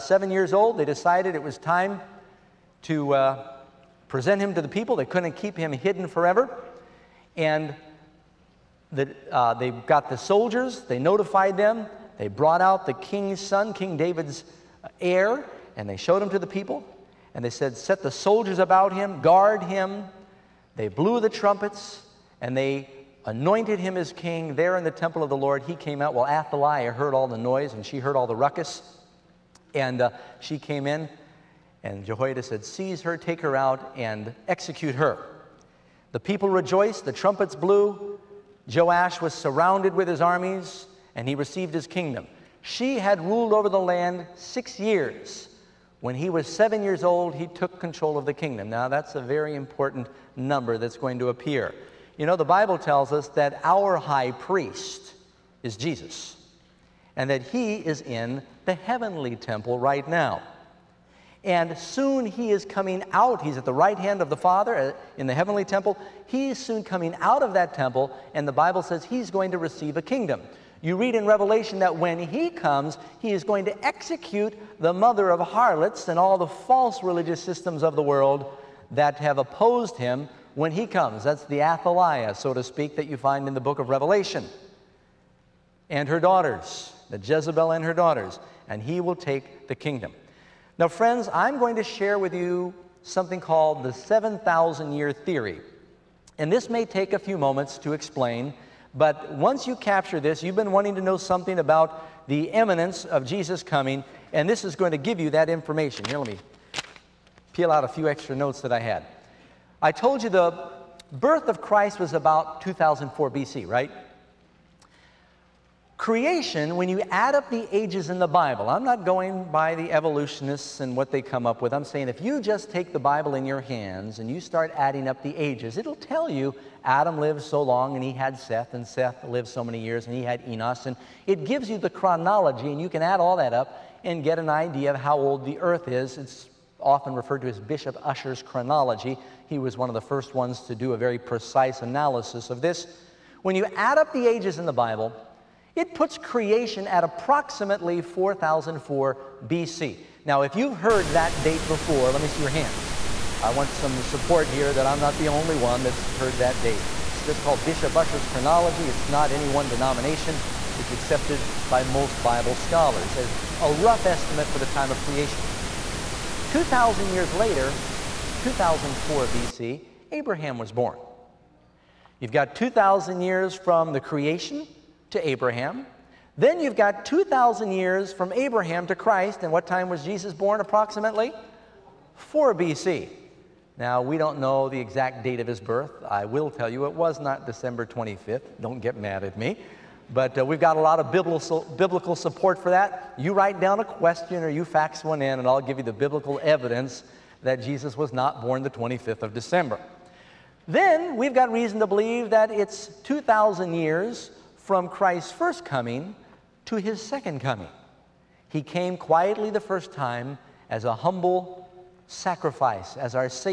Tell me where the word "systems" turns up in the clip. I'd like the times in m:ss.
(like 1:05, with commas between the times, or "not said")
1:17.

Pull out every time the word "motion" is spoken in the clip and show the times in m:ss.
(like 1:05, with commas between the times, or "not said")
not said.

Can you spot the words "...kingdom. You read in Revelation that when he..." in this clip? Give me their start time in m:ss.
1:10.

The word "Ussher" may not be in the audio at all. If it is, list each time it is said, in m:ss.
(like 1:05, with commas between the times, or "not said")
2:18, 2:37.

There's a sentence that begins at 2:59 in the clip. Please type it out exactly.
And what time was Jesus born approximately?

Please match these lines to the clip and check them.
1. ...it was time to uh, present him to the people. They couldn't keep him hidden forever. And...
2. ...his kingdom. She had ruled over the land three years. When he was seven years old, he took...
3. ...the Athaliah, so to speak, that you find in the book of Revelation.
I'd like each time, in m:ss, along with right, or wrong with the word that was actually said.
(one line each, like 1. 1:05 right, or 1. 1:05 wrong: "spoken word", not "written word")
1. 0:01 right
2. 0:41 wrong: "six", not "three"
3. 1:21 right.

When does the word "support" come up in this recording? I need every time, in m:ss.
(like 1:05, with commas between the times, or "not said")
2:34, 3:12.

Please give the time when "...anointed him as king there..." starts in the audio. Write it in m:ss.
0:23.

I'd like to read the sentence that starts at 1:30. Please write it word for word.
Now, friends, I'm going to share with you something called the 7,000 year theory.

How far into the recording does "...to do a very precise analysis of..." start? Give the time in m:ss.
2:20.